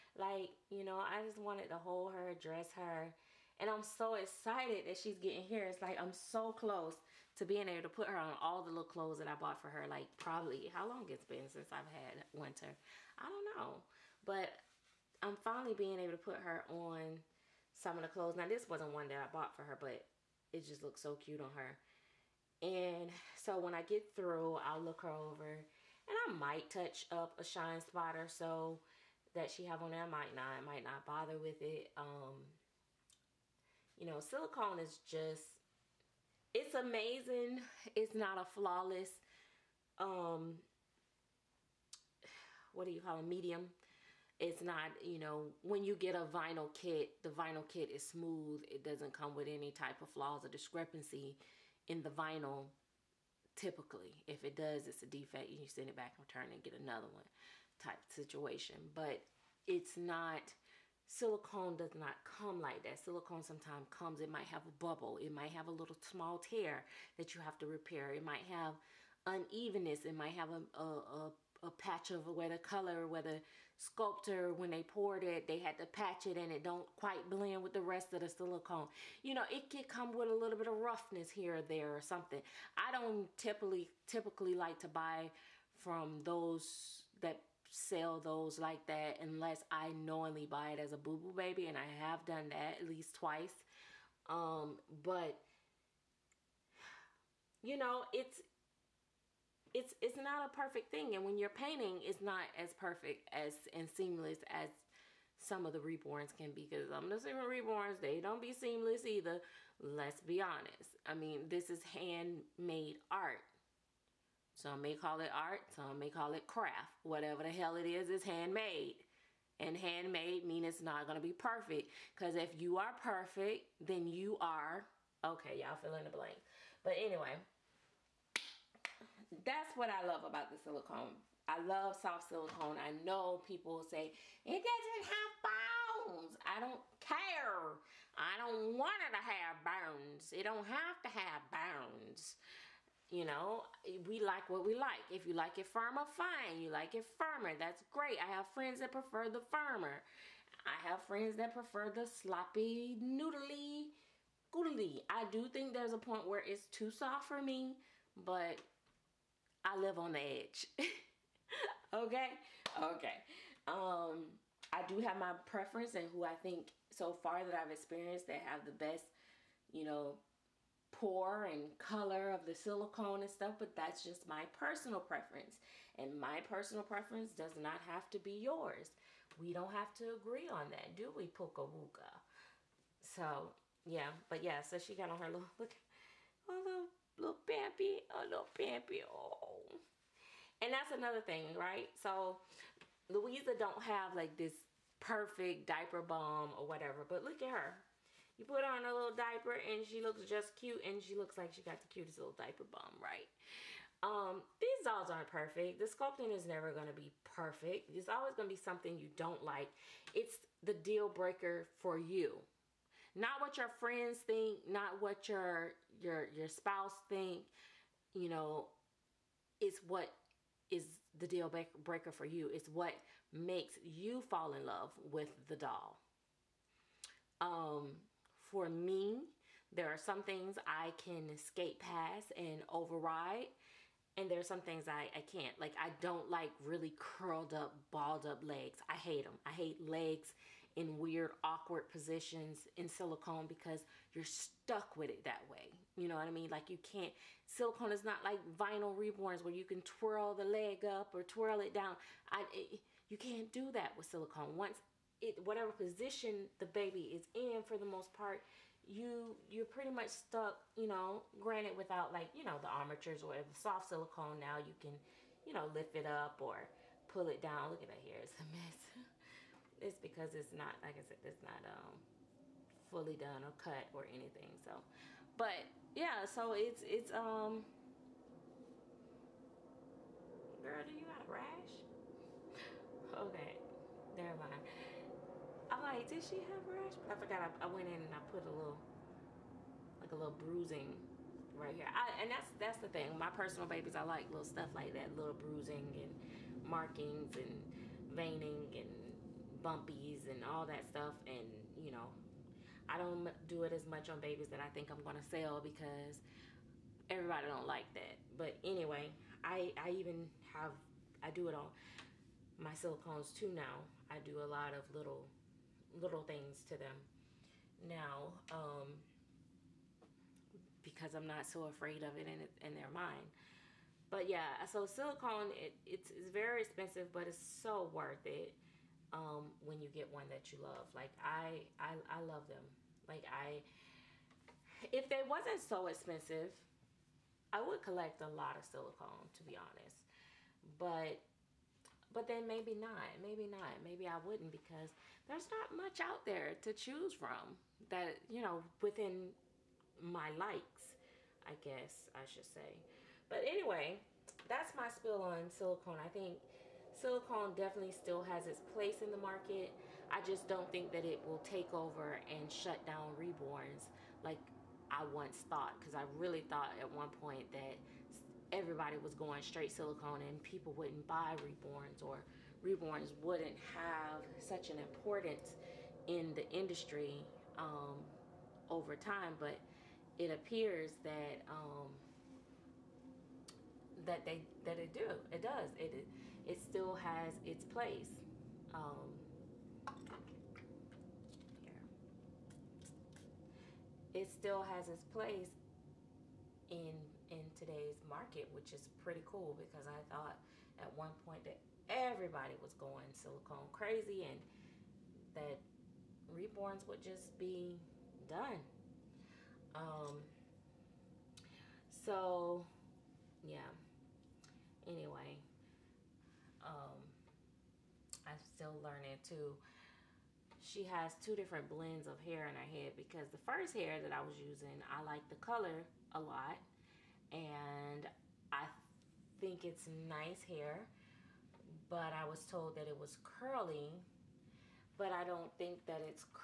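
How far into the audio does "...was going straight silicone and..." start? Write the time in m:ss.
6:08.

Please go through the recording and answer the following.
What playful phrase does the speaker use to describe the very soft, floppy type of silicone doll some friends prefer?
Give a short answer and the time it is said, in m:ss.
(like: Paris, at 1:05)
sloppy, noodly, goodly, at 2:32.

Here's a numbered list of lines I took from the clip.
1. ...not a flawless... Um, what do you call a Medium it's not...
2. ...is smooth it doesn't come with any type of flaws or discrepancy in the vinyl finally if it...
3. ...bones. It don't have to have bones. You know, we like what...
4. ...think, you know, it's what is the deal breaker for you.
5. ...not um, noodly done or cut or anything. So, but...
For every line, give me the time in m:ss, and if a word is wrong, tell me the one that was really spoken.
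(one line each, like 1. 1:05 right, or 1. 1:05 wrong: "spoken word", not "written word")
1. 0:38 right
2. 0:47 wrong: "typically", not "finally"
3. 2:19 right
4. 3:37 right
5. 4:31 wrong: "fully", not "noodly".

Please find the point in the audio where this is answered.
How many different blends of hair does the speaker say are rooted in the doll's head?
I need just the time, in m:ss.
7:01.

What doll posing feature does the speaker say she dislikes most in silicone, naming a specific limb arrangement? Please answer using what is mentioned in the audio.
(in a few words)
balled up legs.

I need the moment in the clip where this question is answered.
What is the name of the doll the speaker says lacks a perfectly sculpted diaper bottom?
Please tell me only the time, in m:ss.
3:13.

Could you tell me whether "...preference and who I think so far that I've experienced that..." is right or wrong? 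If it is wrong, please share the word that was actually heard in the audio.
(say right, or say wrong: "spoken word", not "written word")
right.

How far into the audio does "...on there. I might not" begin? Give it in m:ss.
0:29.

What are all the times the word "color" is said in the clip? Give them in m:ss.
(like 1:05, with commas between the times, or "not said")
1:12, 2:51, 7:05.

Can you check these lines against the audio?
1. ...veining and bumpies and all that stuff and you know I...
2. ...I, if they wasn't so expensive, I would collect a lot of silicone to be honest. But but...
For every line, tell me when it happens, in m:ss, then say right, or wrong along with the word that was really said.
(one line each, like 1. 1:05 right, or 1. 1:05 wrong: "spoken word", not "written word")
1. 4:58 right
2. 5:33 right.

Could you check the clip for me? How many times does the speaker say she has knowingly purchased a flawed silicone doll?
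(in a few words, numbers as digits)
twice.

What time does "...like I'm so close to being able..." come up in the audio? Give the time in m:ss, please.
0:05.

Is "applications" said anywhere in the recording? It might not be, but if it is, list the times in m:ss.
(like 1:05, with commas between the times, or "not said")
not said.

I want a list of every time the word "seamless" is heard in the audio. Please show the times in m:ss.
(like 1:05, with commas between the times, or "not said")
1:43, 1:48.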